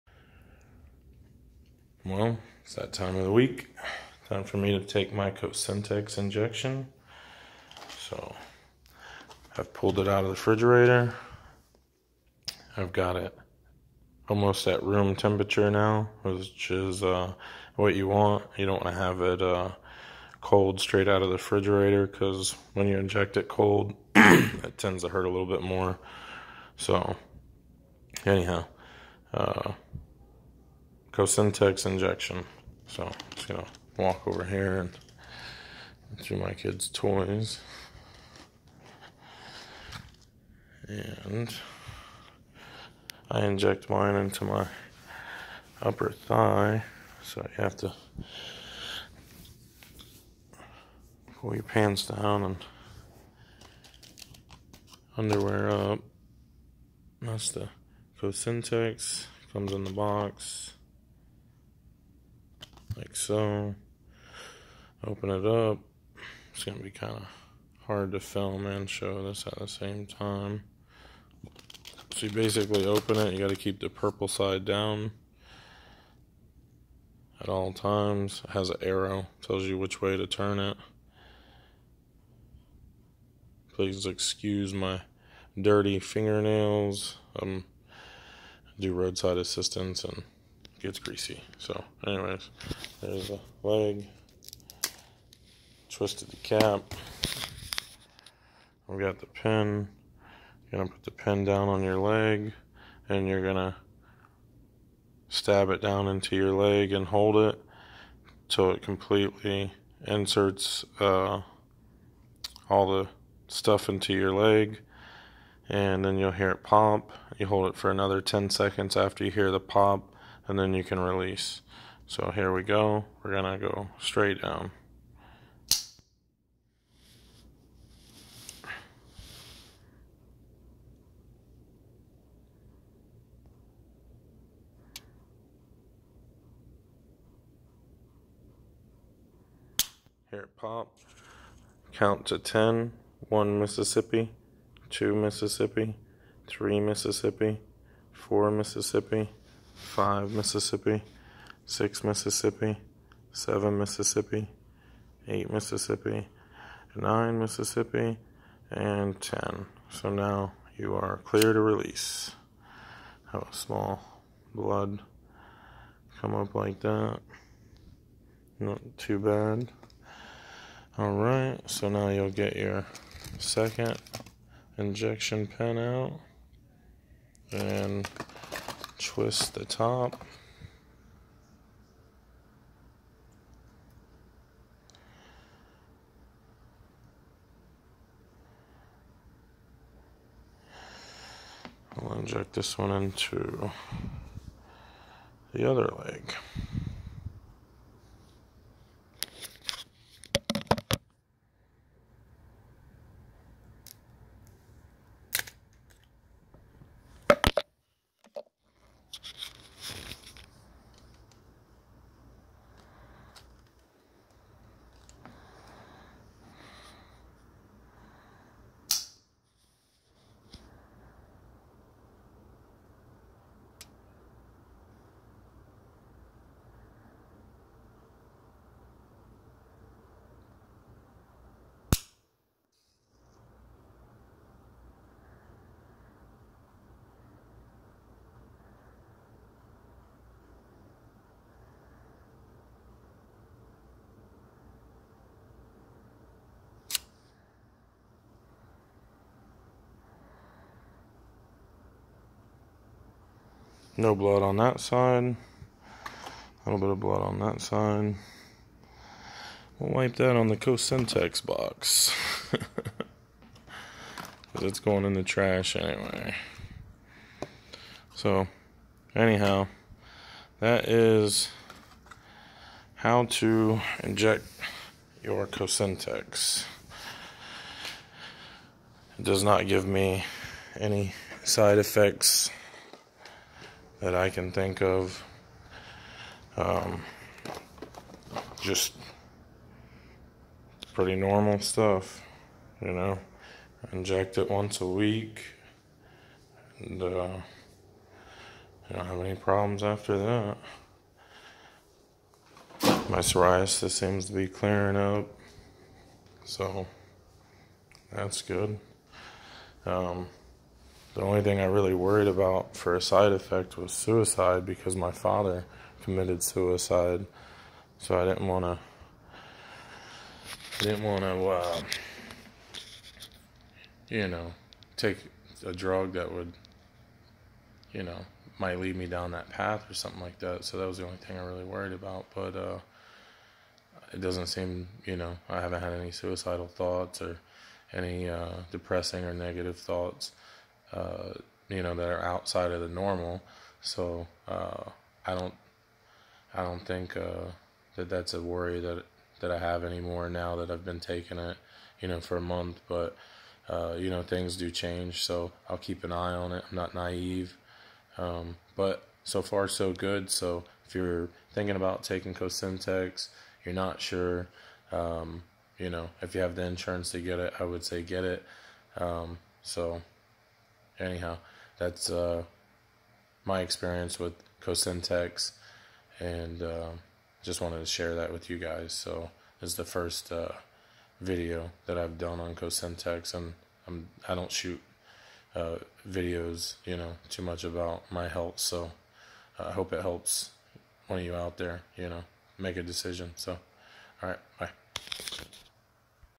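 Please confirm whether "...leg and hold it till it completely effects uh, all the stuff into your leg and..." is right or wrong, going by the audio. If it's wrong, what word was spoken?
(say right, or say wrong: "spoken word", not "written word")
wrong: "inserts", not "effects".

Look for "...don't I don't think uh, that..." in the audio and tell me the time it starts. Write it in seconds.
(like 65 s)
345 s.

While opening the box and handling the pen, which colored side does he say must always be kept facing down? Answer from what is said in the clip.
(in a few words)
Purple.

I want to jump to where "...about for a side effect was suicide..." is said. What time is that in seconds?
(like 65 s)
312 s.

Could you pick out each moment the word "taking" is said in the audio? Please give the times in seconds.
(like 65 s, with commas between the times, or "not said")
350 s, 362 s.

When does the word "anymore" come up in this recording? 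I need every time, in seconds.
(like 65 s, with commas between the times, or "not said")
349 s.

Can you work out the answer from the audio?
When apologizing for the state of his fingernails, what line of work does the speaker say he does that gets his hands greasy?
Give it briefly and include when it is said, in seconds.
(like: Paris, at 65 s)
Roadside assistance, at 88 s.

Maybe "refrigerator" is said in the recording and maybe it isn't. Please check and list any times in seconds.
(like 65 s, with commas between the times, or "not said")
10 s, 21 s.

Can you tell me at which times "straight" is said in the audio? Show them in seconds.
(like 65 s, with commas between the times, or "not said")
20 s, 124 s.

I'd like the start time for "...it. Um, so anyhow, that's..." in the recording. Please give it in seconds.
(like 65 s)
368 s.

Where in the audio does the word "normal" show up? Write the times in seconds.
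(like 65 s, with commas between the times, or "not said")
291 s, 342 s.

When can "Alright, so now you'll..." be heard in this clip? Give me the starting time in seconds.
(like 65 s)
170 s.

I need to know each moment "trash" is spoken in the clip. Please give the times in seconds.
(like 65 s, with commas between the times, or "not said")
265 s.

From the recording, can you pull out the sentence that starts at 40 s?
And I inject mine into my upper thigh.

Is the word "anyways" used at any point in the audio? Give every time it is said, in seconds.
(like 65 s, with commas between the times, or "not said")
92 s, 265 s.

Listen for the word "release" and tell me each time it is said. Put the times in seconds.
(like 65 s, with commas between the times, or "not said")
120 s, 161 s.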